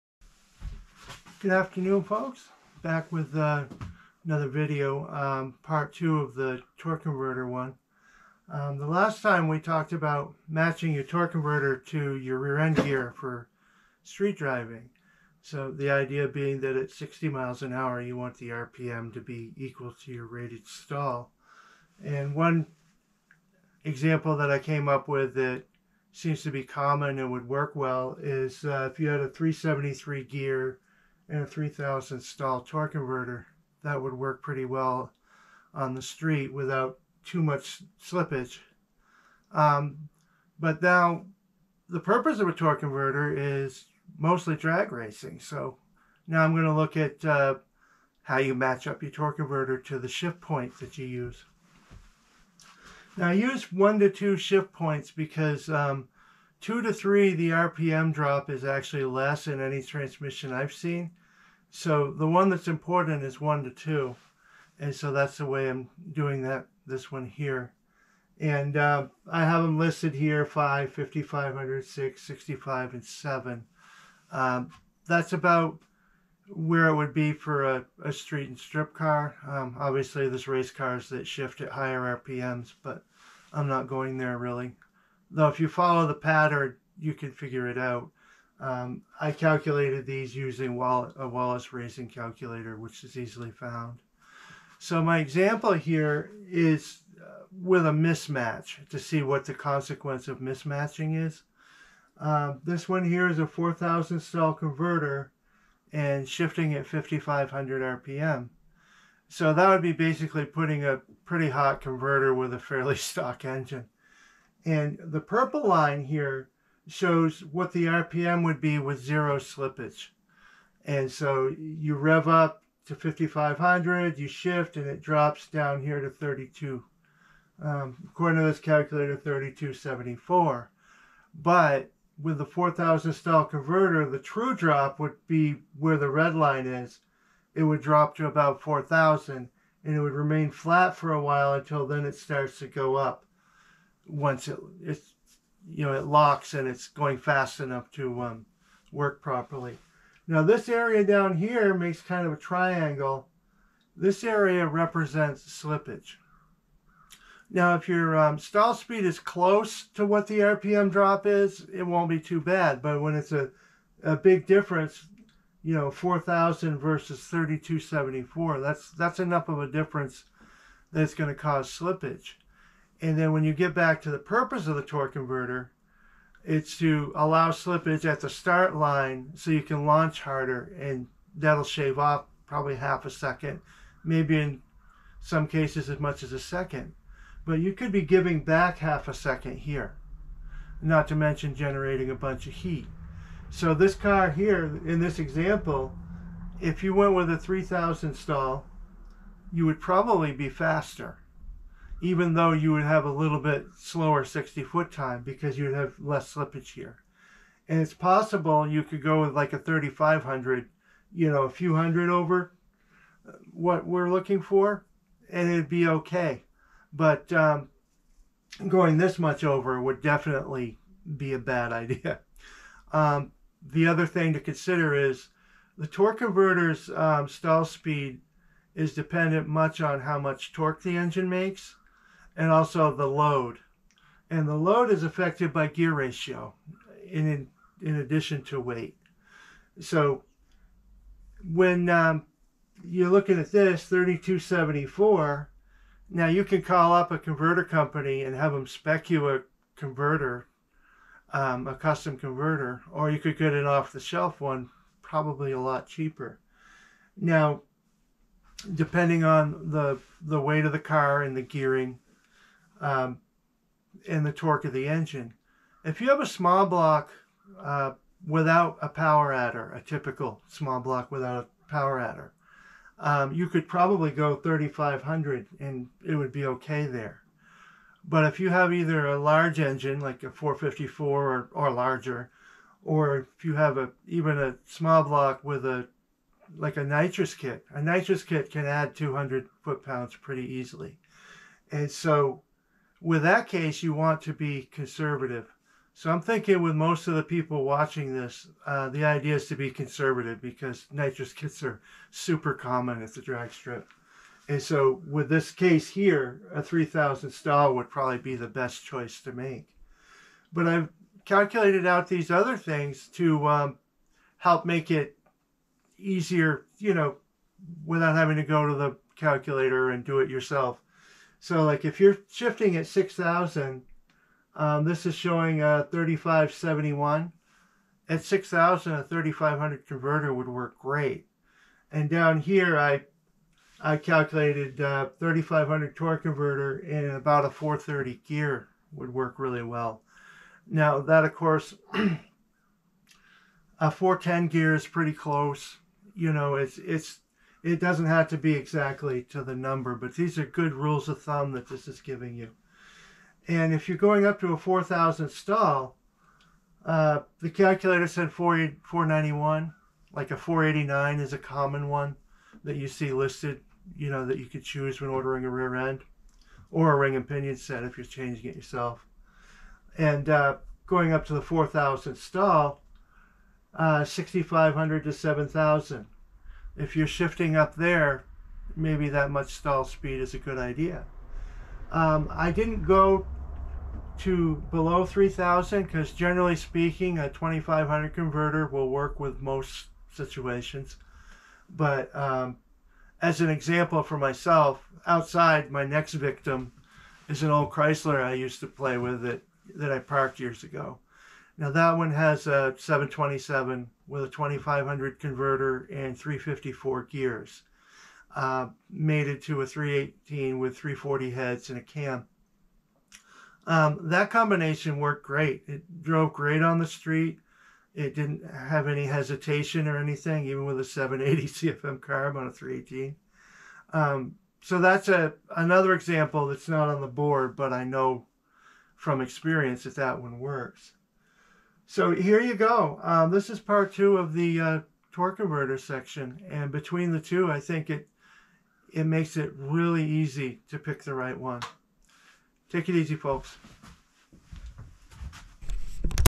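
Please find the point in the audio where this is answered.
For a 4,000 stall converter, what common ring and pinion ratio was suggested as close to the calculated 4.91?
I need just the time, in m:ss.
6:00.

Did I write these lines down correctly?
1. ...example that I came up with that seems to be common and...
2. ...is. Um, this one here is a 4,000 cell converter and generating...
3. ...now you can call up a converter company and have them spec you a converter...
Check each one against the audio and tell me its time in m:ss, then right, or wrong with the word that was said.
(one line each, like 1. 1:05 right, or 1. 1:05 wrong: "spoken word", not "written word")
1. 0:23 right
2. 1:41 wrong: "shifting", not "generating"
3. 4:06 right.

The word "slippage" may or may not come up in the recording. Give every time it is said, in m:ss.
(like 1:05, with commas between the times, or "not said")
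0:38, 1:59, 2:35, 2:51, 2:57, 3:26.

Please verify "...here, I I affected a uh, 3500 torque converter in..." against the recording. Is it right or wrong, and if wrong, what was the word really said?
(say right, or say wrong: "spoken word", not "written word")
wrong: "calculated", not "affected".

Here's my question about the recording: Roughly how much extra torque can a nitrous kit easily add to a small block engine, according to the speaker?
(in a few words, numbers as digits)
200 foot pounds.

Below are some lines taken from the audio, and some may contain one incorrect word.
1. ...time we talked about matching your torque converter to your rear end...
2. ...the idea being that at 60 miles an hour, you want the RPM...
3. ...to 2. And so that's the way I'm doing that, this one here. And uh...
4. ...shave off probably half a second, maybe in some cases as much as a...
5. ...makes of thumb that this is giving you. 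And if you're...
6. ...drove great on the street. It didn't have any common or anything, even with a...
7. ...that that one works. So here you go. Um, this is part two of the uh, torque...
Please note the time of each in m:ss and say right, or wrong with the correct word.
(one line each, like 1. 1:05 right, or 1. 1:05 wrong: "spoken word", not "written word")
1. 0:09 right
2. 0:15 right
3. 1:03 right
4. 3:01 right
5. 5:50 wrong: "rules", not "makes"
6. 6:56 wrong: "hesitation", not "common"
7. 7:09 right.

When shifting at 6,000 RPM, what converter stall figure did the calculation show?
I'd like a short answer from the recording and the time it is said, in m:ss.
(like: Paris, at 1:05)
3571, at 5:25.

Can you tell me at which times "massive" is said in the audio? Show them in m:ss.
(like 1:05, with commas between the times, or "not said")
not said.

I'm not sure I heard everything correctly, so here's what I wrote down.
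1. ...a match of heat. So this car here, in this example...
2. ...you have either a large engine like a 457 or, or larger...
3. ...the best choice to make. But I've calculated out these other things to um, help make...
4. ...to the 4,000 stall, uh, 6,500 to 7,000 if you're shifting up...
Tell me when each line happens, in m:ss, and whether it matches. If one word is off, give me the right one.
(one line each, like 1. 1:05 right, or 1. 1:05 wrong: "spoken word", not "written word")
1. 3:12 wrong: "bunch", not "match"
2. 4:38 wrong: "454", not "457"
3. 5:08 right
4. 6:11 right.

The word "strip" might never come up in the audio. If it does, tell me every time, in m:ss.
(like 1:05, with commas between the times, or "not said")
1:18, 5:03.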